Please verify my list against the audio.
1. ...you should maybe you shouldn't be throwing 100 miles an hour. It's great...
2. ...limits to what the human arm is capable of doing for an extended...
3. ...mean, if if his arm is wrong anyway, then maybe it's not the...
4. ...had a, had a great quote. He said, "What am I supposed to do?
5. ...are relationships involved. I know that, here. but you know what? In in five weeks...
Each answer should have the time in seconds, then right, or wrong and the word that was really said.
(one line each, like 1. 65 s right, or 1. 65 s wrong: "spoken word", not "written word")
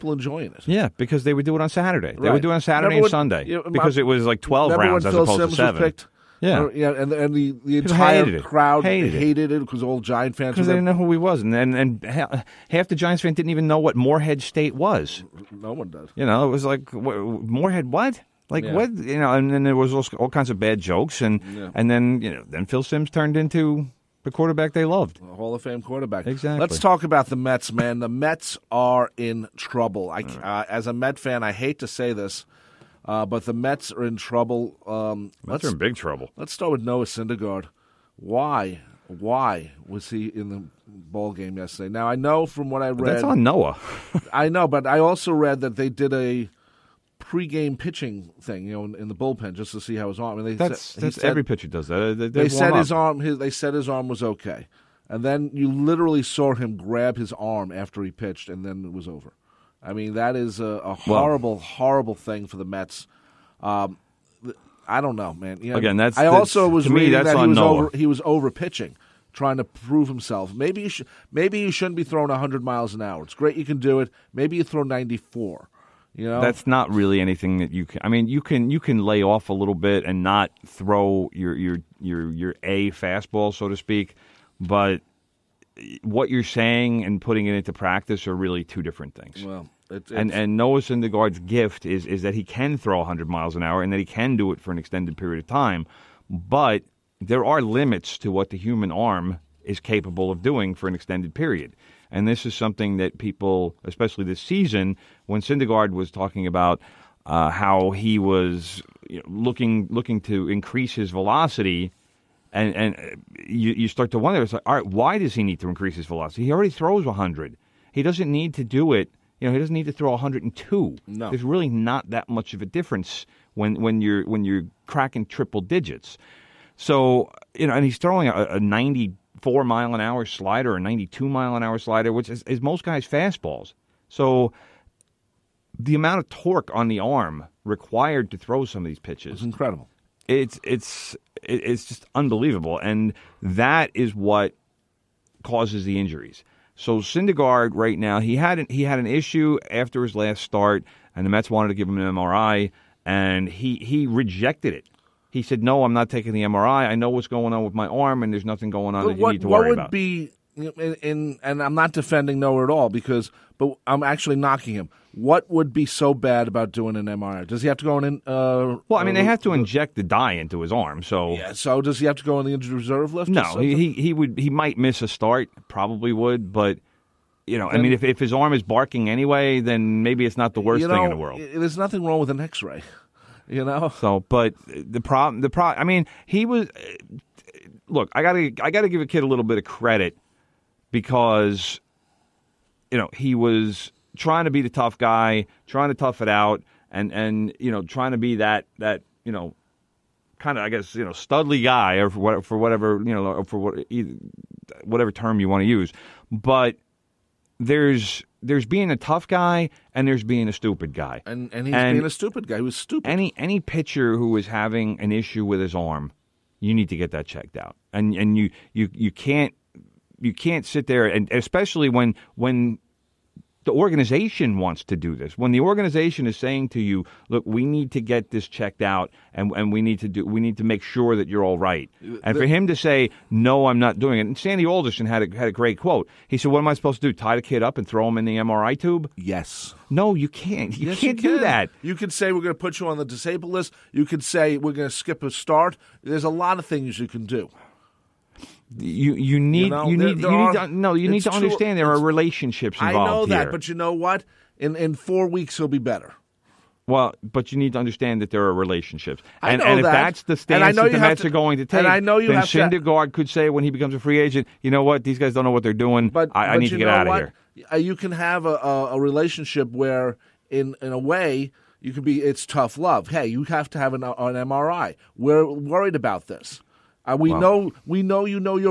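1. 70 s right
2. 97 s right
3. 177 s wrong: "barking", not "wrong"
4. 235 s right
5. 251 s wrong: "four", not "five".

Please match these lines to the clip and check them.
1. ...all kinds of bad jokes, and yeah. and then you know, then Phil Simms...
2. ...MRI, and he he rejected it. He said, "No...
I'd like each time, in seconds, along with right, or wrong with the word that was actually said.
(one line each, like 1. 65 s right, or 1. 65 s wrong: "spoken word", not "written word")
1. 20 s right
2. 152 s right.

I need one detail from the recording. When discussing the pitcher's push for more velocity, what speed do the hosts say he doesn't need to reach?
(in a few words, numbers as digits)
102.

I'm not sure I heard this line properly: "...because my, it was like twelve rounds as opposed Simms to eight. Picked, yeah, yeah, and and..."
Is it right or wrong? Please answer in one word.
wrong.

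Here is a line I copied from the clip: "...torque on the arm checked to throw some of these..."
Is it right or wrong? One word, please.
wrong.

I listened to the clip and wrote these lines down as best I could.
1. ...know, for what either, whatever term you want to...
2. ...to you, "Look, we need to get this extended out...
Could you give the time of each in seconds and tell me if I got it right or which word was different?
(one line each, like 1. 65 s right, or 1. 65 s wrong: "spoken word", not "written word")
1. 203 s right
2. 226 s wrong: "checked", not "extended".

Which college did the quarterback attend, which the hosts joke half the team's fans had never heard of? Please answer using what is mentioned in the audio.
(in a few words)
Morehead State.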